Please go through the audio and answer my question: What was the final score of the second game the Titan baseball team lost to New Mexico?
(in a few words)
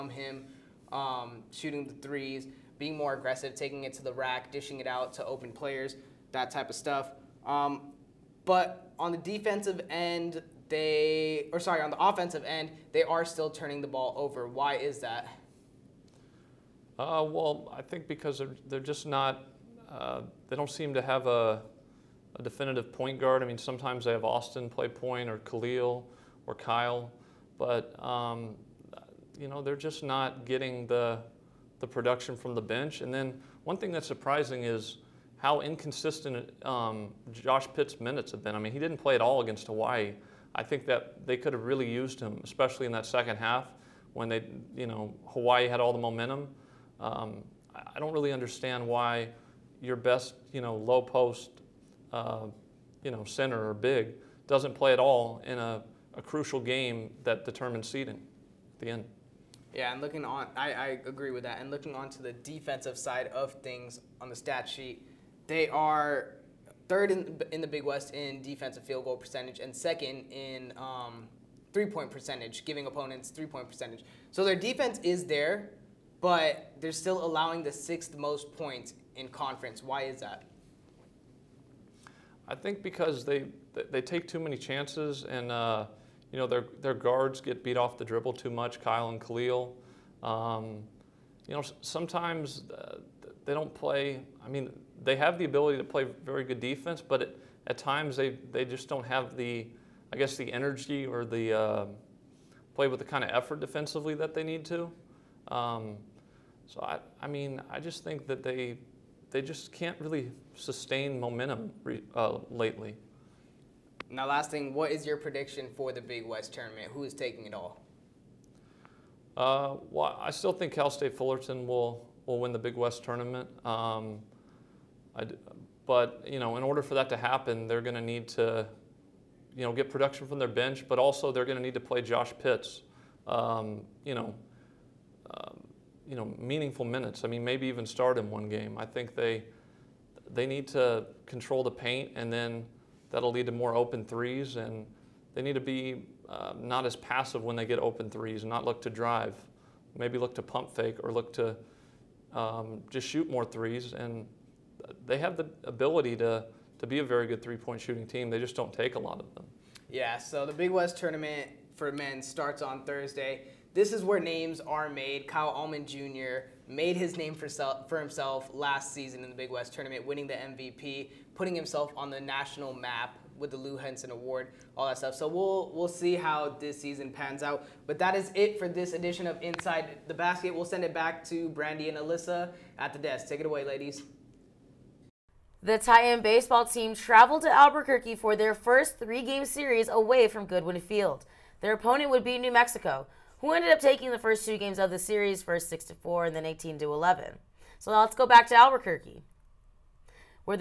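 18 to 11.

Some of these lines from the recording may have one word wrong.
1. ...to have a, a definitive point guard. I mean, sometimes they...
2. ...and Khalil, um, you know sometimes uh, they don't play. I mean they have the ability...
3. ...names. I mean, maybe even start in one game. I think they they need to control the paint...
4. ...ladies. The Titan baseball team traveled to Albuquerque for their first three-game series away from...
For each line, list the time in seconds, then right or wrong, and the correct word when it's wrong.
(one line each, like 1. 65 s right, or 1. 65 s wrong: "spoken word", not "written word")
1. 20 s right
2. 89 s right
3. 136 s wrong: "minutes", not "names"
4. 183 s right.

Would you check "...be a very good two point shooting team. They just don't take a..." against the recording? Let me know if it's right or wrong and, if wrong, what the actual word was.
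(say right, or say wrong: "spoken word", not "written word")
wrong: "three", not "two".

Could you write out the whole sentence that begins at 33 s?
And then one thing that's surprising is how inconsistent um, Josh Pitt's minutes have been.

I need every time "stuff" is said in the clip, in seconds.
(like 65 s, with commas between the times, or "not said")
6 s, 174 s.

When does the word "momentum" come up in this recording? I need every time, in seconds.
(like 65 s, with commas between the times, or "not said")
45 s, 111 s.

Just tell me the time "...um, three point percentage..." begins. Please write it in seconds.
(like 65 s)
70 s.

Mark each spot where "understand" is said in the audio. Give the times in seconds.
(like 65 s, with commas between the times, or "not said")
48 s.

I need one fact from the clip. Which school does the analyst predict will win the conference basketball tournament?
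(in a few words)
Cal State Fullerton.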